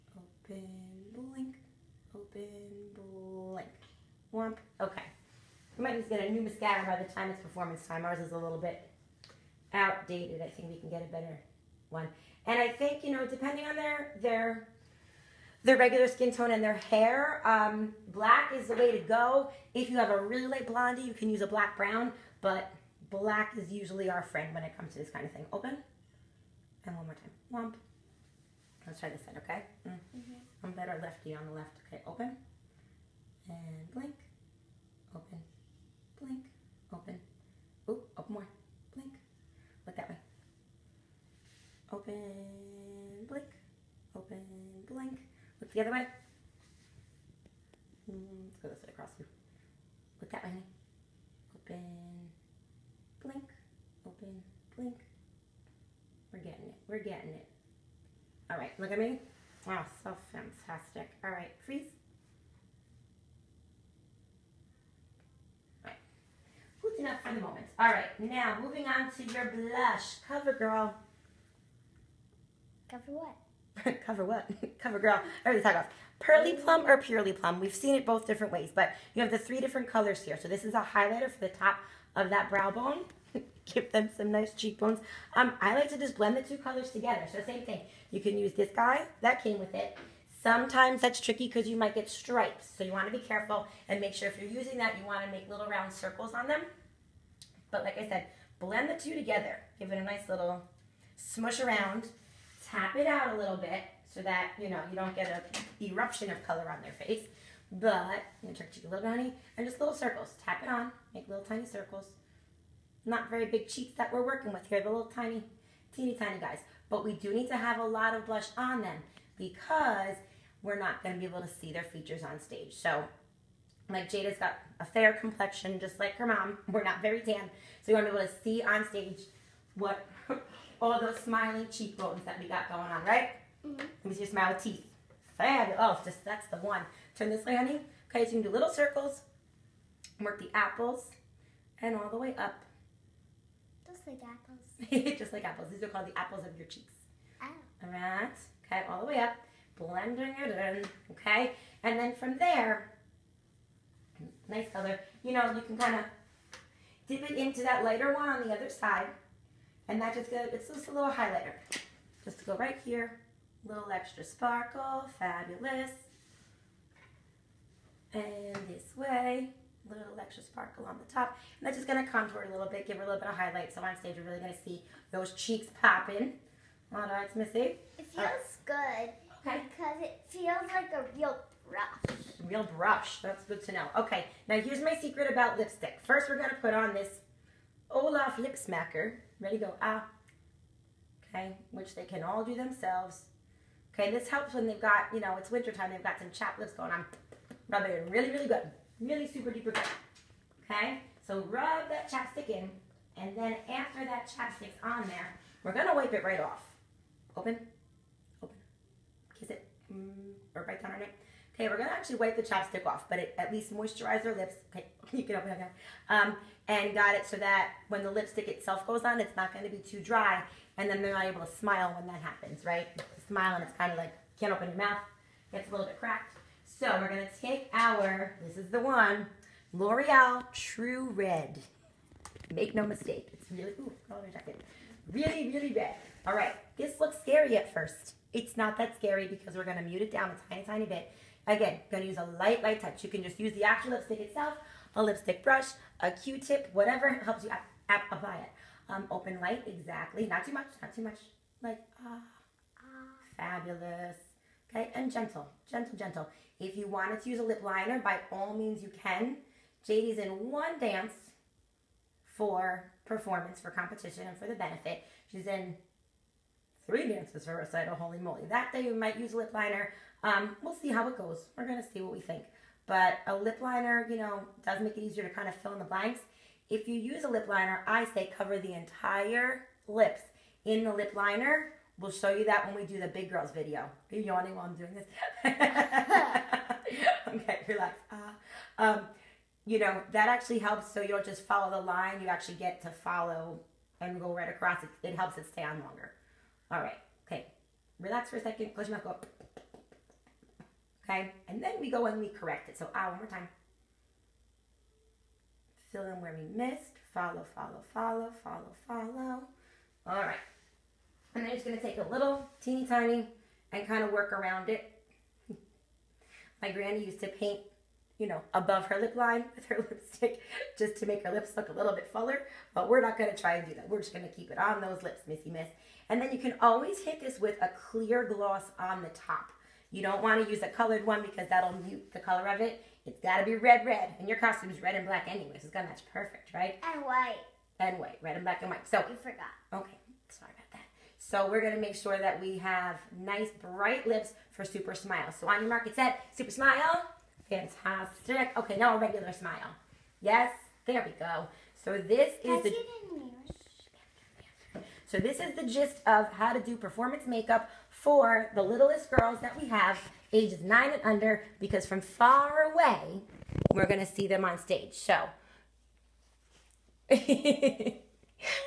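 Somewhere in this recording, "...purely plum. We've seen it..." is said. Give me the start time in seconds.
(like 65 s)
76 s.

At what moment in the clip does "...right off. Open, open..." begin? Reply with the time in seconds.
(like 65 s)
206 s.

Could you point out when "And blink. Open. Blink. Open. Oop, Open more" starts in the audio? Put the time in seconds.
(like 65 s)
33 s.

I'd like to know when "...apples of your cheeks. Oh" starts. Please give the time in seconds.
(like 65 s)
146 s.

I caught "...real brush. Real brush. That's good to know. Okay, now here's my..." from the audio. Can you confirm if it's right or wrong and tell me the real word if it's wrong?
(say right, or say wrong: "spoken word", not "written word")
right.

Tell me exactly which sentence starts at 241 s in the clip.
Again, going to use a light, light touch.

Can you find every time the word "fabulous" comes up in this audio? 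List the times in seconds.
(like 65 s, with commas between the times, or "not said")
135 s, 165 s, 253 s.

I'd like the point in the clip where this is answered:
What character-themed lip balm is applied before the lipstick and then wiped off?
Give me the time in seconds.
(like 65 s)
187 s.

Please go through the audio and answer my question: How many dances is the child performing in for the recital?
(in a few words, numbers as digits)
3.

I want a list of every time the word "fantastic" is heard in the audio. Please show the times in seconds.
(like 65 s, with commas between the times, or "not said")
60 s, 347 s.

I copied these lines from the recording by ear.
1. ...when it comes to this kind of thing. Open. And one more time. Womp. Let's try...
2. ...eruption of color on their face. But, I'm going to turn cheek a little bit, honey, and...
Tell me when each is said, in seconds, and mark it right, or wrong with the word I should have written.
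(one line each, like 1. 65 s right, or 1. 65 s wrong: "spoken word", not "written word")
1. 24 s right
2. 105 s right.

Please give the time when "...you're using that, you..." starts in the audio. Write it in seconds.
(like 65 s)
94 s.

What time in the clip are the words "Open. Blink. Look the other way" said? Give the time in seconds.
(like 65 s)
44 s.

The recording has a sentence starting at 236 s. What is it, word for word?
All right, this looks scary at first.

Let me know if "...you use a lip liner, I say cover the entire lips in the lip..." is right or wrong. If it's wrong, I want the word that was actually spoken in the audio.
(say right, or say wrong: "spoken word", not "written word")
right.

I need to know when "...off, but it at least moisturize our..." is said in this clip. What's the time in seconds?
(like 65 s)
212 s.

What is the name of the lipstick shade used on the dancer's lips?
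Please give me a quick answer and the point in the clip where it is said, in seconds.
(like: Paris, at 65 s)
L'Oreal True Red, at 229 s.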